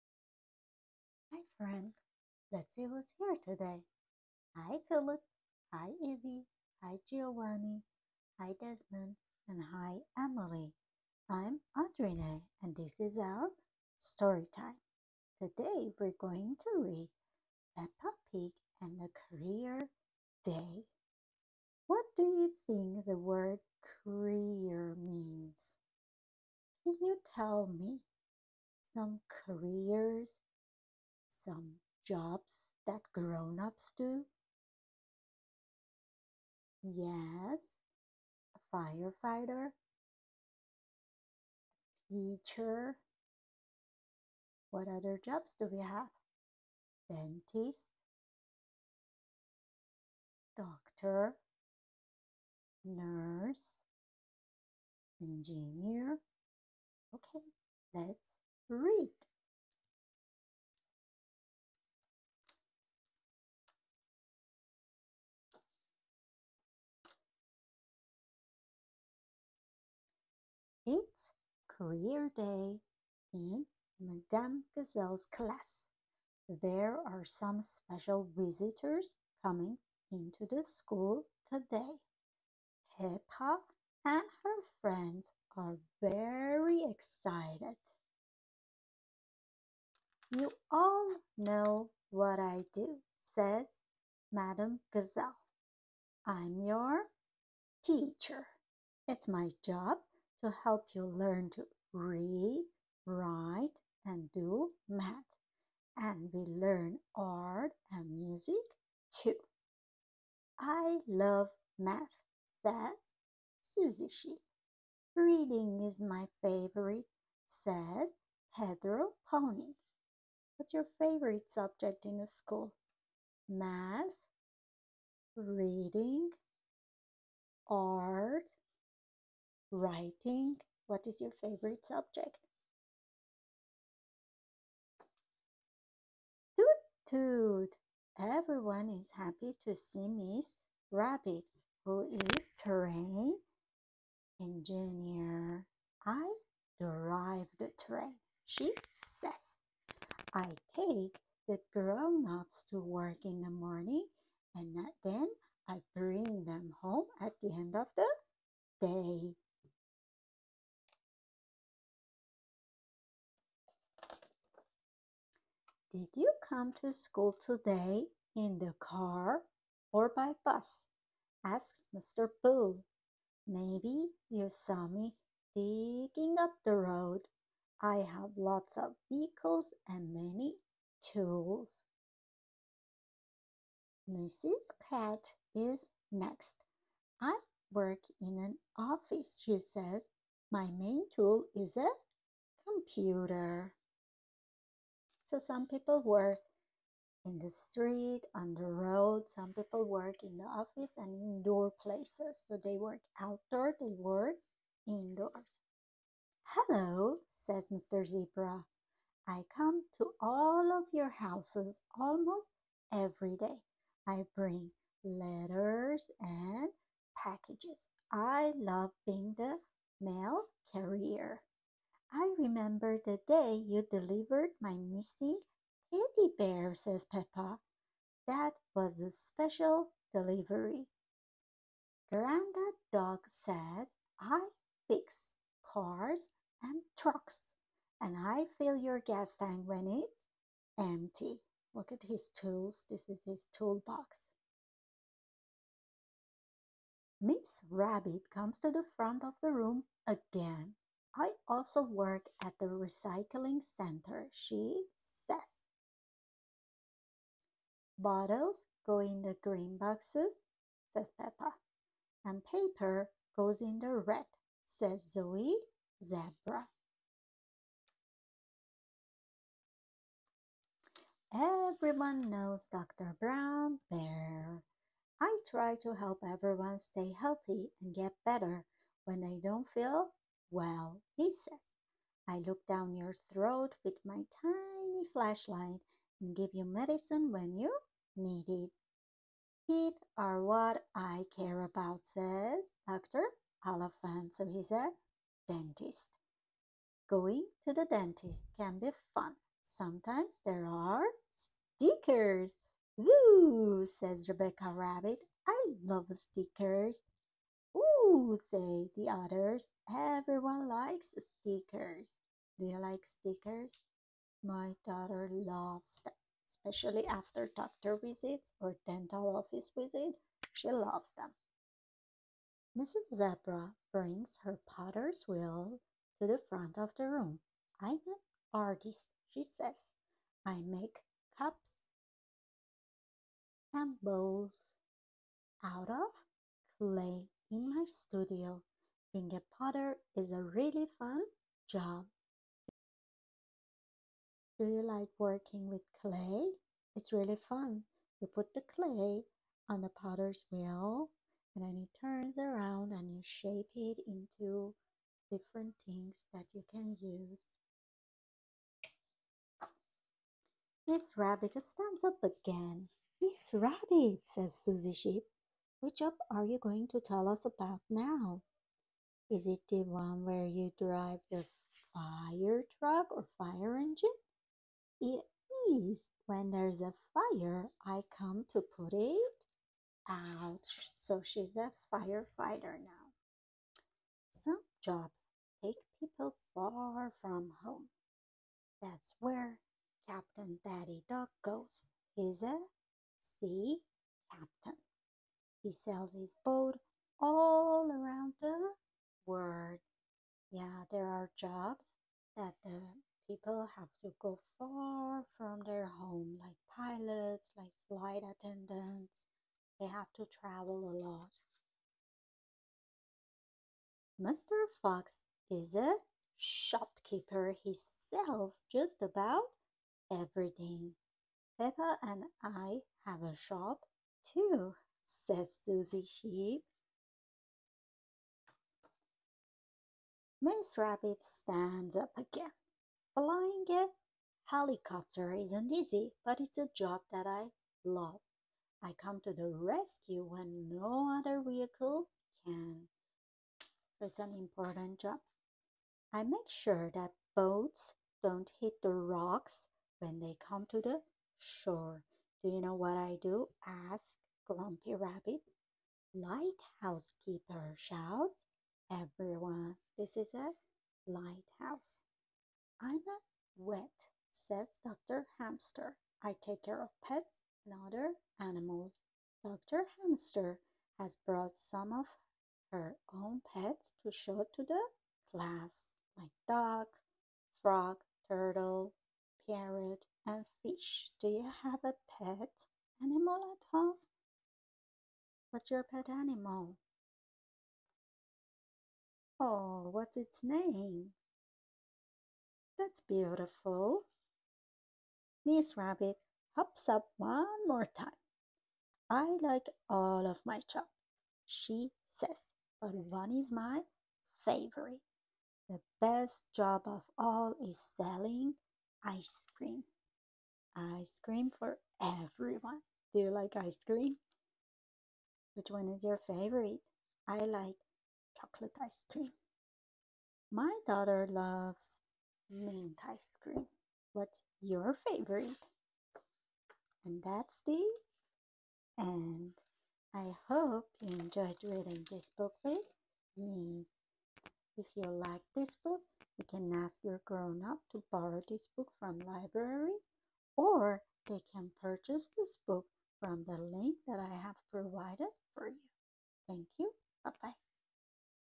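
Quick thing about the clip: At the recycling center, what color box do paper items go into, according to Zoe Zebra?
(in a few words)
red.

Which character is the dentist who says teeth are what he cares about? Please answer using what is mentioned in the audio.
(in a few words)
Dr. Elephant.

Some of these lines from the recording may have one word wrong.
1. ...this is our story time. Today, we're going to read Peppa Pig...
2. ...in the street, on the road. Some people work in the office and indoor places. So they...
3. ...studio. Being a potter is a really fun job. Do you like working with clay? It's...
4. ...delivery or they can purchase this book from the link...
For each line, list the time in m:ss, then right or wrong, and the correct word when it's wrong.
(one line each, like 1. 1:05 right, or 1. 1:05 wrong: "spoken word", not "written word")
1. 0:12 right
2. 3:17 right
3. 5:37 right
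4. 8:59 wrong: "library", not "delivery".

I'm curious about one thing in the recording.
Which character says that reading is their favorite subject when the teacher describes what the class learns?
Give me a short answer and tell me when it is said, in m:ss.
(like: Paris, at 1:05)
Pedro Pony, at 1:58.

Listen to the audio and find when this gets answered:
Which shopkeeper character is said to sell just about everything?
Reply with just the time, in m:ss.
6:54.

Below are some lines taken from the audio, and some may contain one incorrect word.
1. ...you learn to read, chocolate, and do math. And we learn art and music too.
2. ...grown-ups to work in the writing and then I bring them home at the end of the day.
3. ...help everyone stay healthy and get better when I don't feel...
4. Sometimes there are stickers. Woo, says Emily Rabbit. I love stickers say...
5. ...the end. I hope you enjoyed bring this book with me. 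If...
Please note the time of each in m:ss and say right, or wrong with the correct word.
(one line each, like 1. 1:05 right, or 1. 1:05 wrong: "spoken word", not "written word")
1. 1:40 wrong: "write", not "chocolate"
2. 2:31 wrong: "morning", not "writing"
3. 4:35 right
4. 4:59 wrong: "Rebecca", not "Emily"
5. 8:47 wrong: "reading", not "bring".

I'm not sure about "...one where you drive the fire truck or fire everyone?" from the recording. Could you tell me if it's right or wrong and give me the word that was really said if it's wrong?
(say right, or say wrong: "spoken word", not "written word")
wrong: "engine", not "everyone".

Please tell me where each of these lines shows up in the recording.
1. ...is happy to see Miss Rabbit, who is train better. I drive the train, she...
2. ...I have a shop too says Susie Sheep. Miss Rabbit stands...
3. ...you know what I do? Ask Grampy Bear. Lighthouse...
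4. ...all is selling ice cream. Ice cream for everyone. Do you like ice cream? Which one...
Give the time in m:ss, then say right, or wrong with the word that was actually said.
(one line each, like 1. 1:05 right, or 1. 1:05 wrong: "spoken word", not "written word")
1. 2:18 wrong: "engineer", not "better"
2. 7:02 right
3. 7:32 wrong: "Rabbit", not "Bear"
4. 8:27 right.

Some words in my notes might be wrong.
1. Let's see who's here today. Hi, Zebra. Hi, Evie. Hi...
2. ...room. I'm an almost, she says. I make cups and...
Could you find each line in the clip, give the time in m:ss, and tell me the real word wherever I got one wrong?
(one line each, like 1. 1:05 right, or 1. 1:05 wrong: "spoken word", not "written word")
1. 0:02 wrong: "Philip", not "Zebra"
2. 5:27 wrong: "artist", not "almost".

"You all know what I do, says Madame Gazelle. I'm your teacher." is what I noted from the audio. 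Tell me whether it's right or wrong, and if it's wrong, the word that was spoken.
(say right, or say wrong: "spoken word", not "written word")
right.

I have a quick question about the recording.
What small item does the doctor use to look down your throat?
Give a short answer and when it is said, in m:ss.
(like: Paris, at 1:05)
tiny flashlight, at 4:44.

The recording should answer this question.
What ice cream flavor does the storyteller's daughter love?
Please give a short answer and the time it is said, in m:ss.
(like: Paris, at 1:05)
mint, at 8:42.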